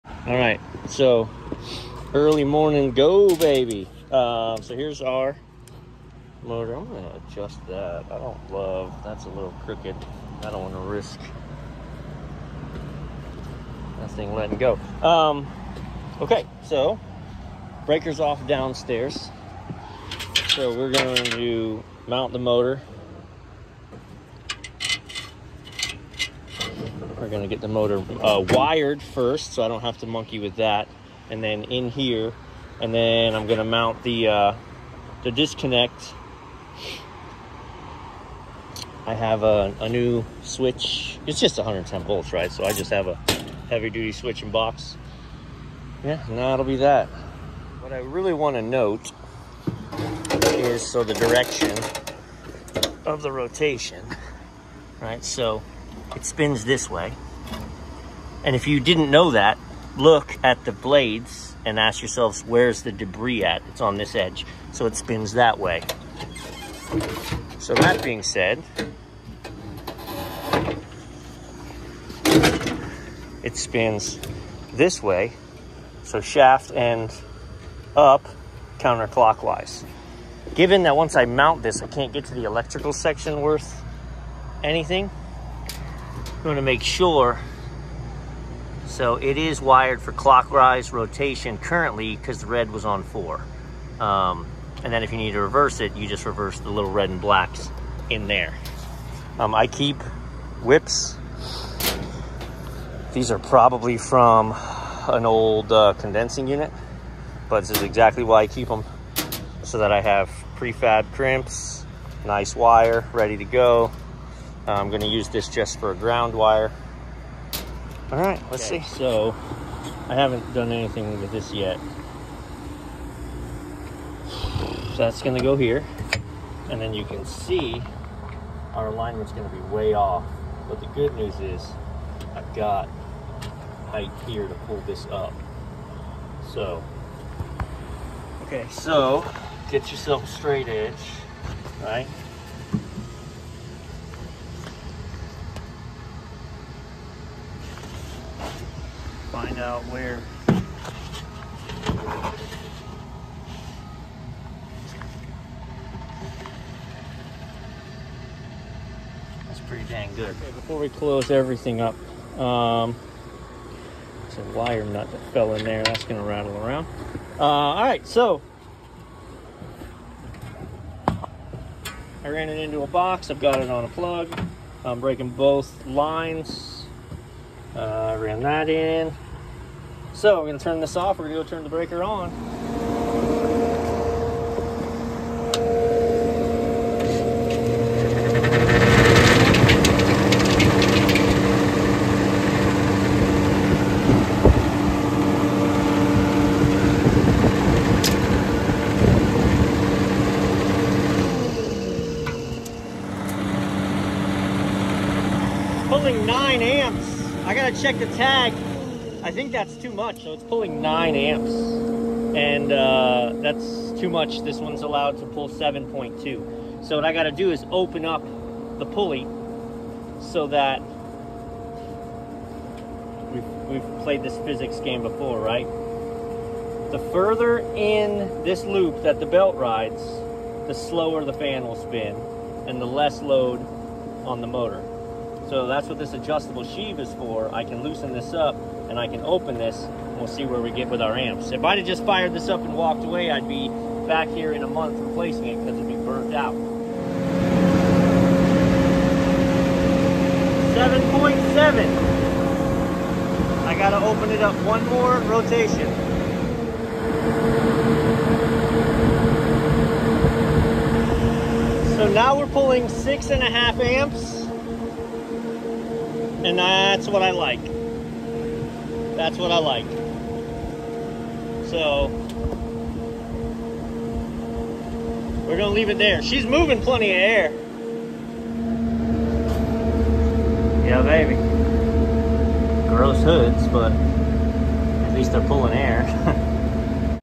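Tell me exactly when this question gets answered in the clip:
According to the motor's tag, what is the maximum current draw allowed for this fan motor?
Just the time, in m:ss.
3:35.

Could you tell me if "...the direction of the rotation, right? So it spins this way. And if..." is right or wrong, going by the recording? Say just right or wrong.
right.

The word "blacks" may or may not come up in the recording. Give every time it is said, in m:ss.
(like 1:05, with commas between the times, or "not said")
1:37.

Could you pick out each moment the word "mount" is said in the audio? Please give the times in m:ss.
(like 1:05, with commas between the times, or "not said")
0:22, 0:33, 1:21.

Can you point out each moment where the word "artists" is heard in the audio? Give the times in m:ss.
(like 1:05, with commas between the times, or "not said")
not said.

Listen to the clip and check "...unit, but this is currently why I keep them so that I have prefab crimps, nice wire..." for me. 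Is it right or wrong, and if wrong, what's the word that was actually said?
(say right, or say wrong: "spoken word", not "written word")
wrong: "exactly", not "currently".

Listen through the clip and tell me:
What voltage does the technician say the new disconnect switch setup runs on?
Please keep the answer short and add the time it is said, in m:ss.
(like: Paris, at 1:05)
110 volts, at 0:41.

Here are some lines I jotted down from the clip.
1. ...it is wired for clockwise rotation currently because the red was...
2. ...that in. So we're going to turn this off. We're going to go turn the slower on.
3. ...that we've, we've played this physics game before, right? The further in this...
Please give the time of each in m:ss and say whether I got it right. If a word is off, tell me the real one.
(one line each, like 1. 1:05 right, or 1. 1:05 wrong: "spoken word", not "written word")
1. 1:29 right
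2. 2:58 wrong: "breaker", not "slower"
3. 3:40 right.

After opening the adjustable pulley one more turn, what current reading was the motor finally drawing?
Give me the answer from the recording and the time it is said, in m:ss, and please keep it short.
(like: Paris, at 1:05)
6.5 amps, at 4:22.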